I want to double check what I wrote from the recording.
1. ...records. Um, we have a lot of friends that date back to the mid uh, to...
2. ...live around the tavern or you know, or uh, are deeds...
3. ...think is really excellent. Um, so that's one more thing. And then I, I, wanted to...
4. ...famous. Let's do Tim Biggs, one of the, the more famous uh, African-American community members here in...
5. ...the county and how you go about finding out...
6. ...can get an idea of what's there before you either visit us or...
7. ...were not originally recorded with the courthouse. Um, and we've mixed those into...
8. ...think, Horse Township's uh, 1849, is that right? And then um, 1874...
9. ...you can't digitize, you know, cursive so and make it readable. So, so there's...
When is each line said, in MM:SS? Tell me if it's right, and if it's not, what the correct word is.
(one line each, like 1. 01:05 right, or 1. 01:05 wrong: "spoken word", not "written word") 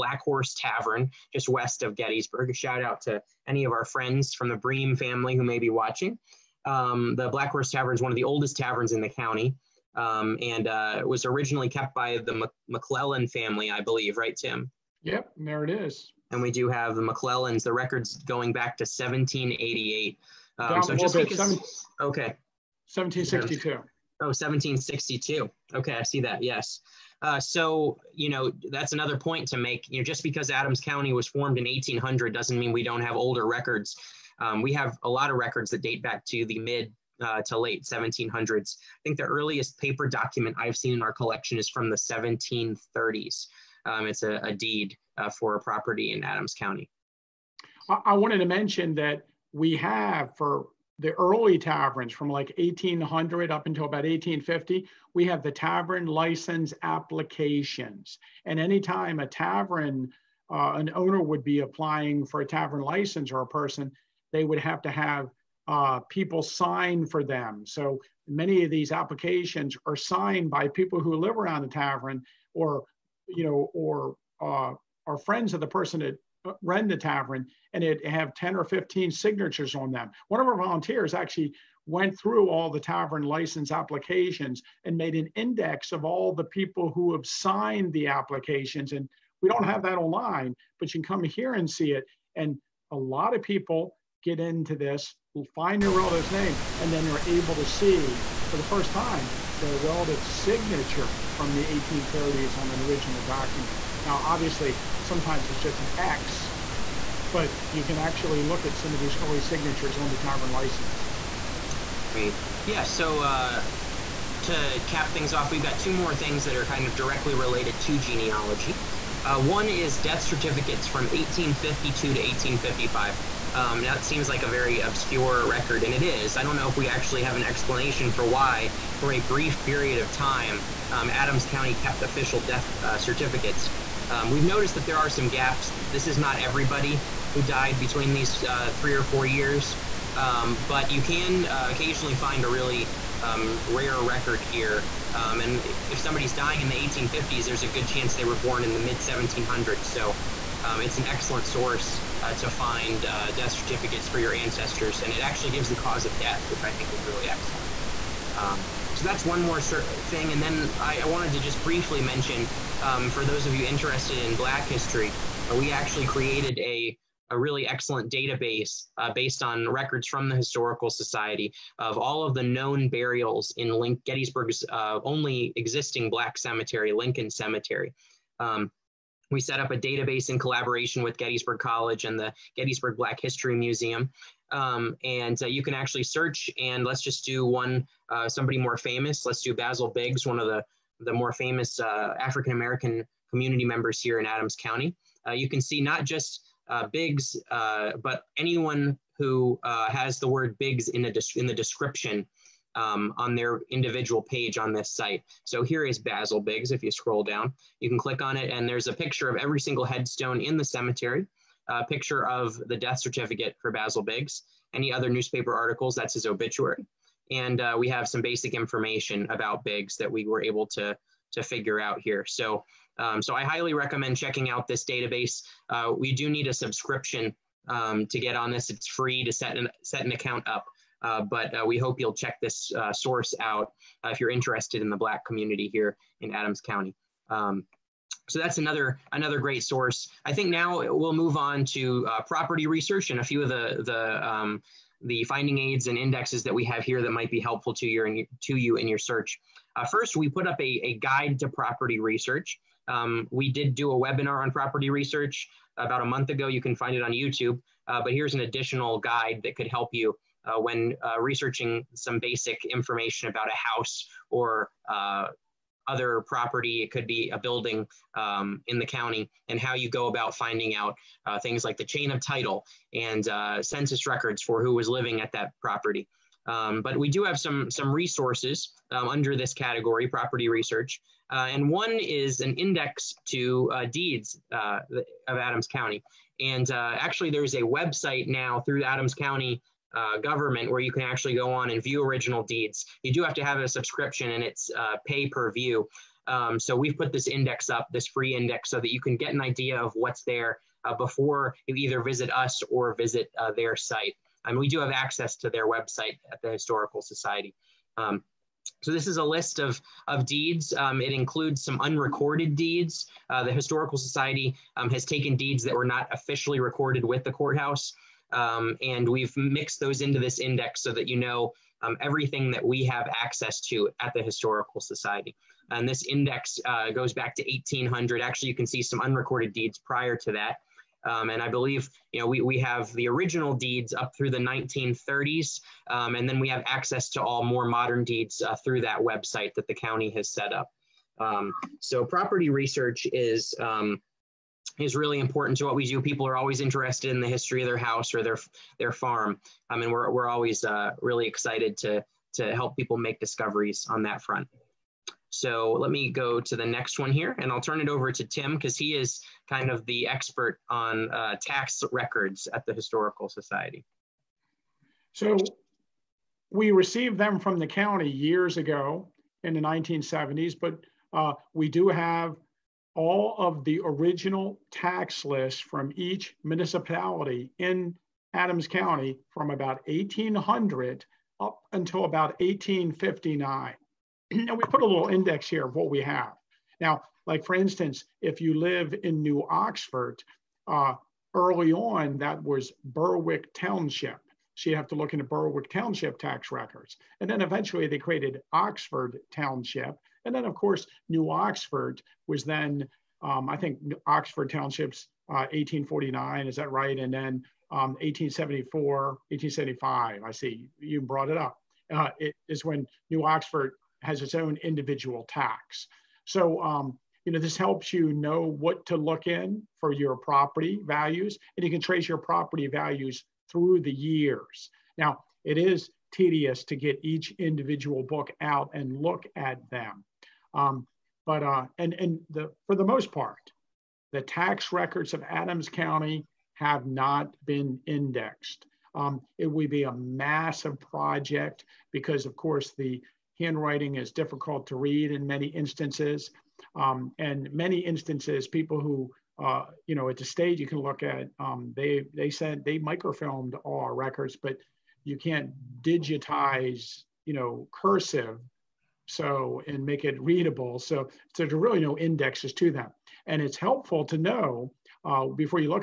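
1. 00:33 wrong: "records", not "friends"
2. 01:11 wrong: "friends", not "deeds"
3. 02:36 right
4. 03:08 wrong: "Basil", not "Tim"
5. 04:28 right
6. 04:58 right
7. 05:15 wrong: "officially", not "originally"
8. 06:43 wrong: "Oxford", not "Horse"
9. 07:35 right.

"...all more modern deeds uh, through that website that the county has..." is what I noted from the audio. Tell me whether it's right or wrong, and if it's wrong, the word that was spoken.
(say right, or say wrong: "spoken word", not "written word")
right.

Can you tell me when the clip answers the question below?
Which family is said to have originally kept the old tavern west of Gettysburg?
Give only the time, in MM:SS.
00:12.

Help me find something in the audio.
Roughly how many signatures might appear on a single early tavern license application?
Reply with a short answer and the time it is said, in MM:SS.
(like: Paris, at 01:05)
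10 or 15, at 01:18.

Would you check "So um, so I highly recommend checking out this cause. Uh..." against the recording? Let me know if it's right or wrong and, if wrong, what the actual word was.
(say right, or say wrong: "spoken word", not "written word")
wrong: "database", not "cause".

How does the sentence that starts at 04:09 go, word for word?
Uh, first, we put up a, a guide to property research.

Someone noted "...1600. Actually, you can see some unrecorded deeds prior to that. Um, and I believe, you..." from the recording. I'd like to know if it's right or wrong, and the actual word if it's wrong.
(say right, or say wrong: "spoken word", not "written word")
wrong: "1800", not "1600".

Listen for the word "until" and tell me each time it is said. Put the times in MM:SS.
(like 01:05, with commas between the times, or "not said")
00:53, 06:21.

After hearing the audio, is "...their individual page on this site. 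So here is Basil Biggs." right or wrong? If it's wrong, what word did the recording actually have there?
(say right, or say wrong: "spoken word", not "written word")
right.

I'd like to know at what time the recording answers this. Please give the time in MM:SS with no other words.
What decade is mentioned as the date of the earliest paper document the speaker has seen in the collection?
00:41.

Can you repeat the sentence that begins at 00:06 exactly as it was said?
Um, the Black Horse Tavern is one of the oldest taverns in the county.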